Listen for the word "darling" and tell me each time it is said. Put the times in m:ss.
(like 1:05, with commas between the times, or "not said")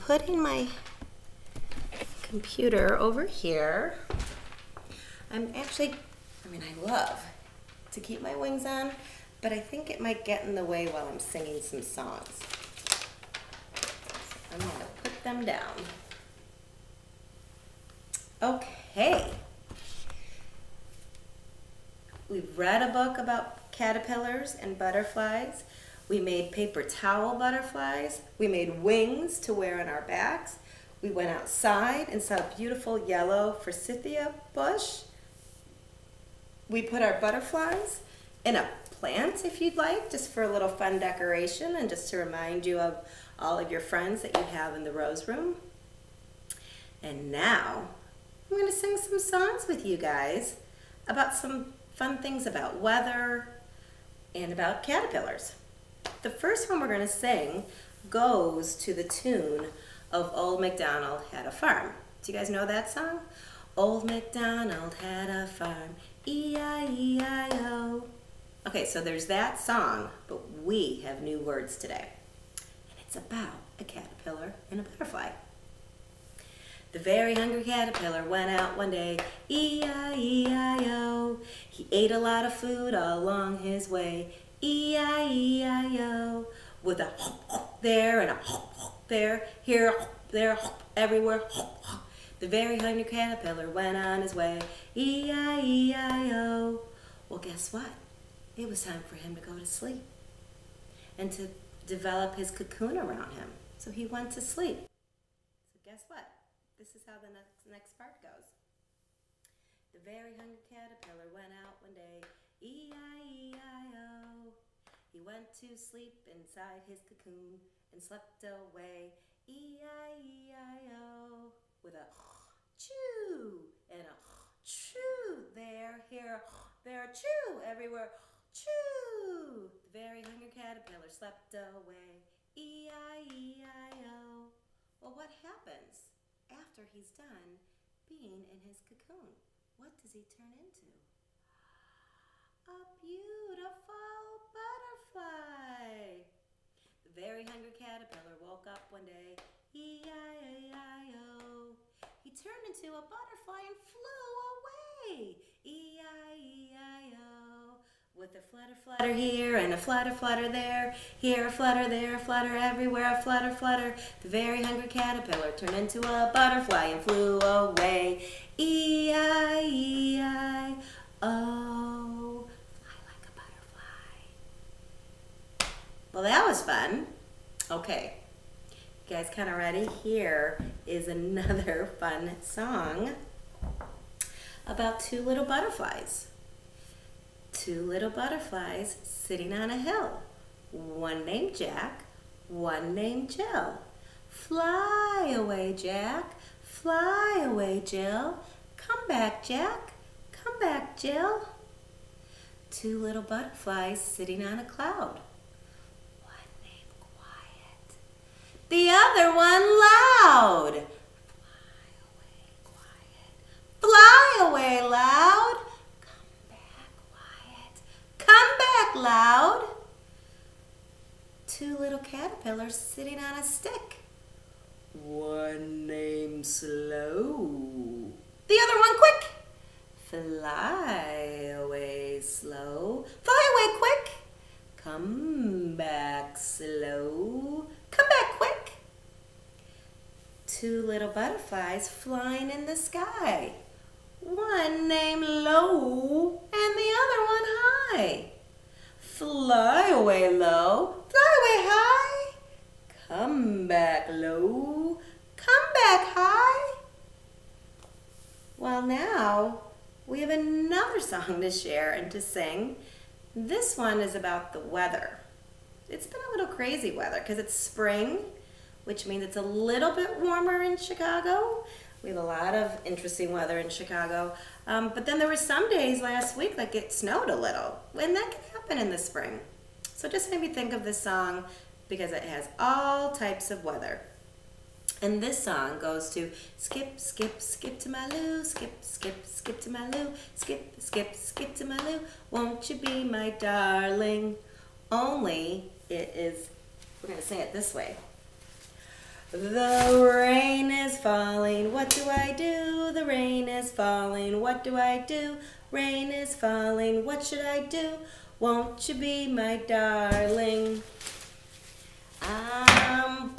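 4:53, 5:09.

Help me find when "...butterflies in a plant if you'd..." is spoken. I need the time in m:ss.
0:37.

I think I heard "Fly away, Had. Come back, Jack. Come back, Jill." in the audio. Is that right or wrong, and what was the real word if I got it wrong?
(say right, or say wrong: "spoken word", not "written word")
wrong: "Jill", not "Had".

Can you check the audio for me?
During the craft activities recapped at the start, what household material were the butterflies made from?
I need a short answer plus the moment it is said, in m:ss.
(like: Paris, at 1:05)
paper towel, at 0:26.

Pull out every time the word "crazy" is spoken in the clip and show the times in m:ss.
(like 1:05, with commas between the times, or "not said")
4:26.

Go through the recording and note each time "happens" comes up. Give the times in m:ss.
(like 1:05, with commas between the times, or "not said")
2:15, 4:38.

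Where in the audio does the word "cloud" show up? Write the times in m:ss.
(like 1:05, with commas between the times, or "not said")
3:24.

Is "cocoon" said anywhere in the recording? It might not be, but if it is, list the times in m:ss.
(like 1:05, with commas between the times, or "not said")
1:42, 1:57, 2:18.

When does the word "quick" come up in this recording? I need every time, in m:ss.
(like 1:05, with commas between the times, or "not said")
3:48, 3:53, 3:58.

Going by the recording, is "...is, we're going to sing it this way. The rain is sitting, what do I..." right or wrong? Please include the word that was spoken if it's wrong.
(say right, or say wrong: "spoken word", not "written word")
wrong: "falling", not "sitting".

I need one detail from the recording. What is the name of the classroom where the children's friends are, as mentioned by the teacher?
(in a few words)
Rose Room.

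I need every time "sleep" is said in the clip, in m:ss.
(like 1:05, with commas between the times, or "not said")
1:39, 1:44, 1:55.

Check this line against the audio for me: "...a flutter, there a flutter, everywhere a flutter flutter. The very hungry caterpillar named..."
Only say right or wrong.
wrong.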